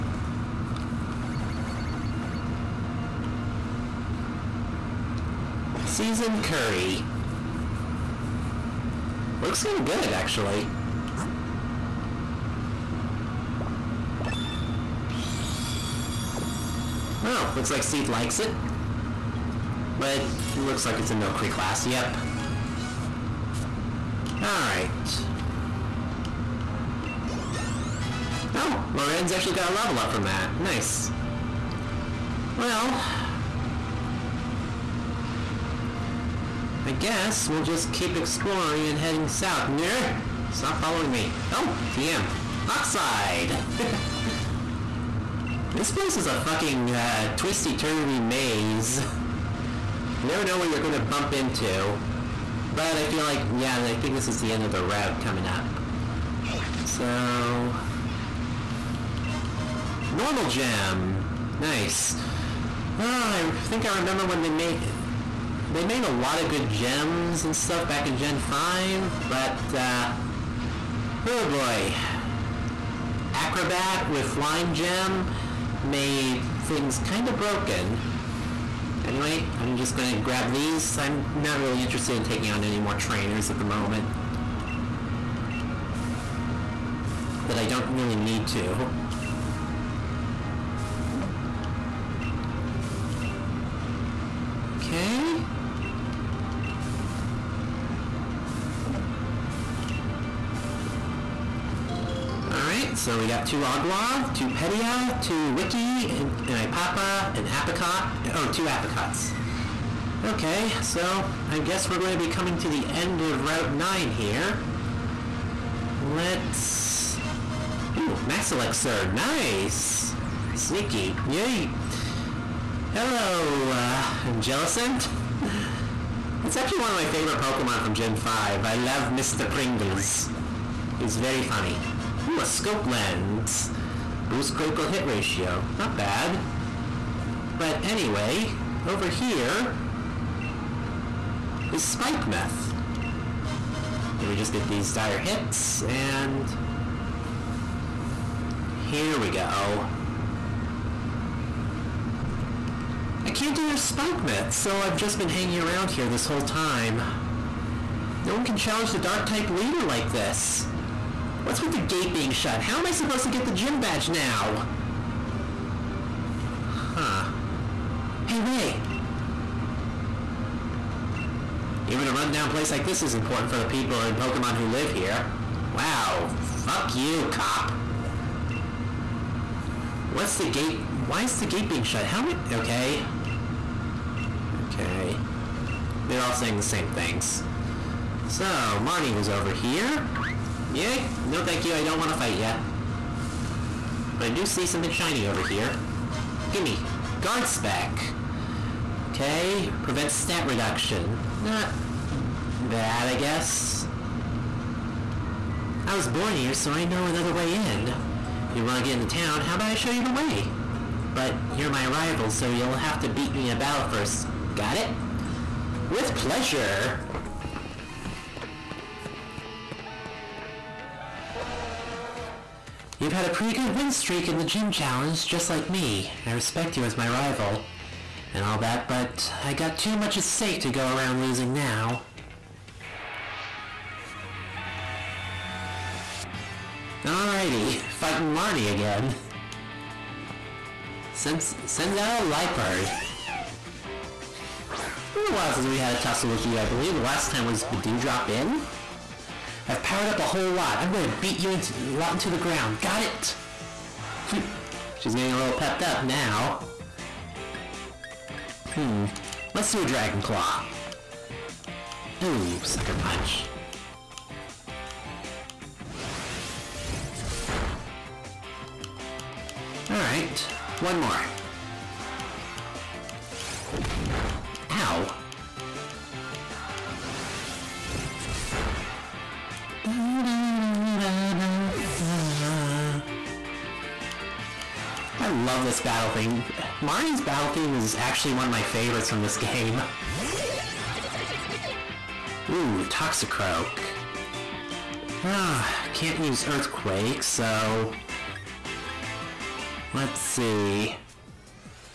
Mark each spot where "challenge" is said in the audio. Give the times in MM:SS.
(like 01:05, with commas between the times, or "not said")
02:38, 03:44.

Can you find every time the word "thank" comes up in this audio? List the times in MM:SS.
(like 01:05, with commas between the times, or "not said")
03:11.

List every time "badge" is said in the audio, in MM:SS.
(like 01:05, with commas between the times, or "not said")
02:43.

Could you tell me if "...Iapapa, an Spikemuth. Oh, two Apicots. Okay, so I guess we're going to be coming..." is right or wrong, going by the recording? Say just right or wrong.
wrong.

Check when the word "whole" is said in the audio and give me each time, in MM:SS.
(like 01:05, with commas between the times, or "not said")
02:36, 04:10.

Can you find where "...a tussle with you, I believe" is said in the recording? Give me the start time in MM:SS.
04:05.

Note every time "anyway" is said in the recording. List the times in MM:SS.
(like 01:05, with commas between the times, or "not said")
01:19, 02:17.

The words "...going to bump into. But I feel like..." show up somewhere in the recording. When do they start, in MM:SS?
00:50.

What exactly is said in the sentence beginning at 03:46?
I respect you as my rival.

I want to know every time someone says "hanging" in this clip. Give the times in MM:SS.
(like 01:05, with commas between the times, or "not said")
02:35.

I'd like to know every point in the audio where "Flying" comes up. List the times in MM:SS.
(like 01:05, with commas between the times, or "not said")
01:14.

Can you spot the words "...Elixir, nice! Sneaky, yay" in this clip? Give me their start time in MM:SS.
01:58.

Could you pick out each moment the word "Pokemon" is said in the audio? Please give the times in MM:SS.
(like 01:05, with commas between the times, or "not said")
02:07, 02:54.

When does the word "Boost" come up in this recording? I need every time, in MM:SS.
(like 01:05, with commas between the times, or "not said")
02:14.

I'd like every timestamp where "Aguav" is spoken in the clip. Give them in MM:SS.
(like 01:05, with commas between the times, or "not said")
01:43.